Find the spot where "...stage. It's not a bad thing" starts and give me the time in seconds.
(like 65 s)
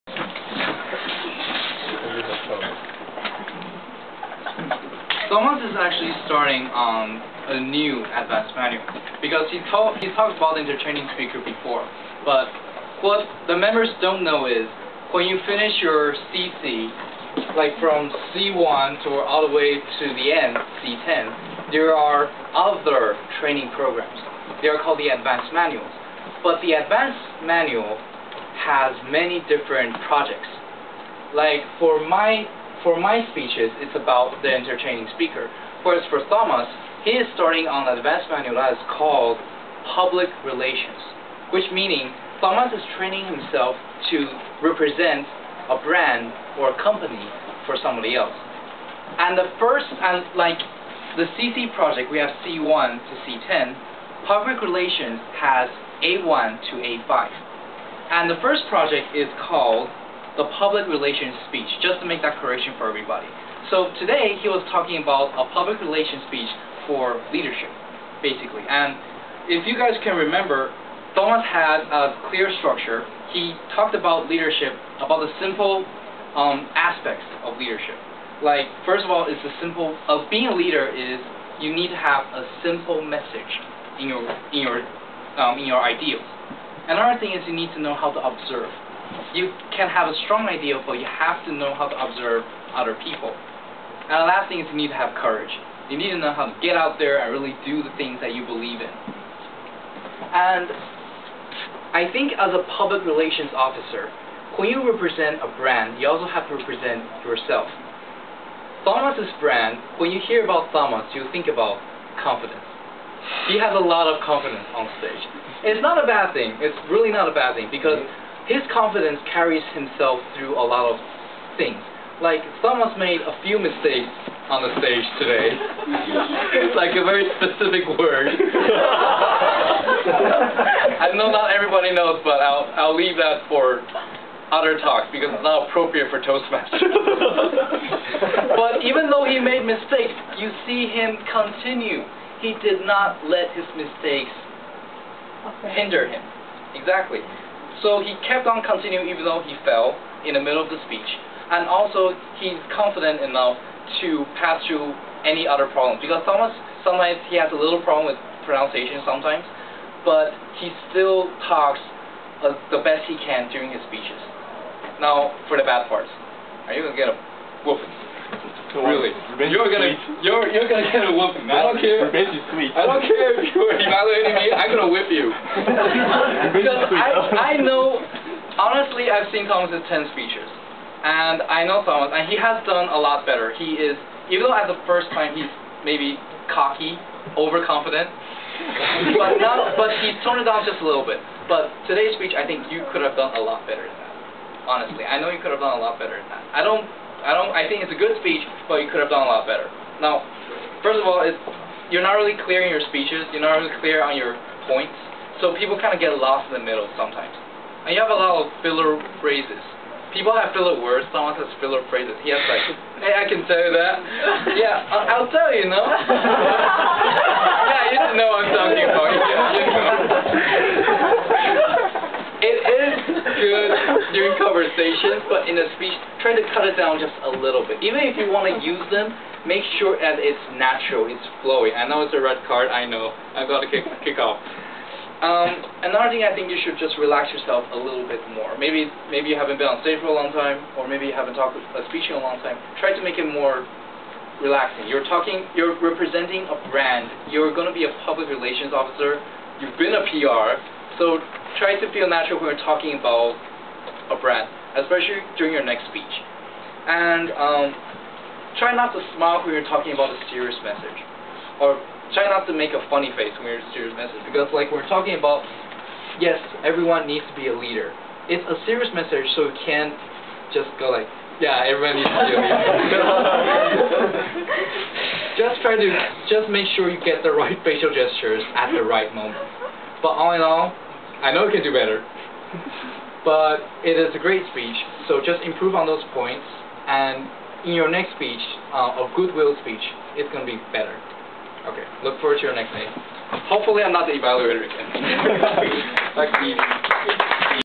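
114 s.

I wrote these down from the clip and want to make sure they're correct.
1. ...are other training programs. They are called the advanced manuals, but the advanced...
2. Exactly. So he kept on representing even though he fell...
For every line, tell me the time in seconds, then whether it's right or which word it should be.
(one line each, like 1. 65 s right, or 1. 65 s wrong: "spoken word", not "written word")
1. 21 s right
2. 146 s wrong: "continuing", not "representing".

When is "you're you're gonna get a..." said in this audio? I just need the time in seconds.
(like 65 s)
170 s.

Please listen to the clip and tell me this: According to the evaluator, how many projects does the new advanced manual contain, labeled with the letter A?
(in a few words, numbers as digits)
5.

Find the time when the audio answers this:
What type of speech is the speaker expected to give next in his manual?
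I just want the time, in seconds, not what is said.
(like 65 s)
289 s.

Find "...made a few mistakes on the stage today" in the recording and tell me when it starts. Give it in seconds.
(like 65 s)
122 s.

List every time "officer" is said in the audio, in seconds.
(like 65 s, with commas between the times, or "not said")
103 s, 248 s.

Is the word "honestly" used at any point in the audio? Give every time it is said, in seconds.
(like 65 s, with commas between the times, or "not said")
178 s, 194 s.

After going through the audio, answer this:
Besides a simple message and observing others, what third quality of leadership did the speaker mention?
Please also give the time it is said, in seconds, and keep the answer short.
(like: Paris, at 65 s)
Courage, at 95 s.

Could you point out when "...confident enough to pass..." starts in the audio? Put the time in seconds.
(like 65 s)
152 s.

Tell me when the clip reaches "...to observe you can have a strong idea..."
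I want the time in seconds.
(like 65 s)
88 s.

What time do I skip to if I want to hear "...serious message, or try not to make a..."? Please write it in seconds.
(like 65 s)
260 s.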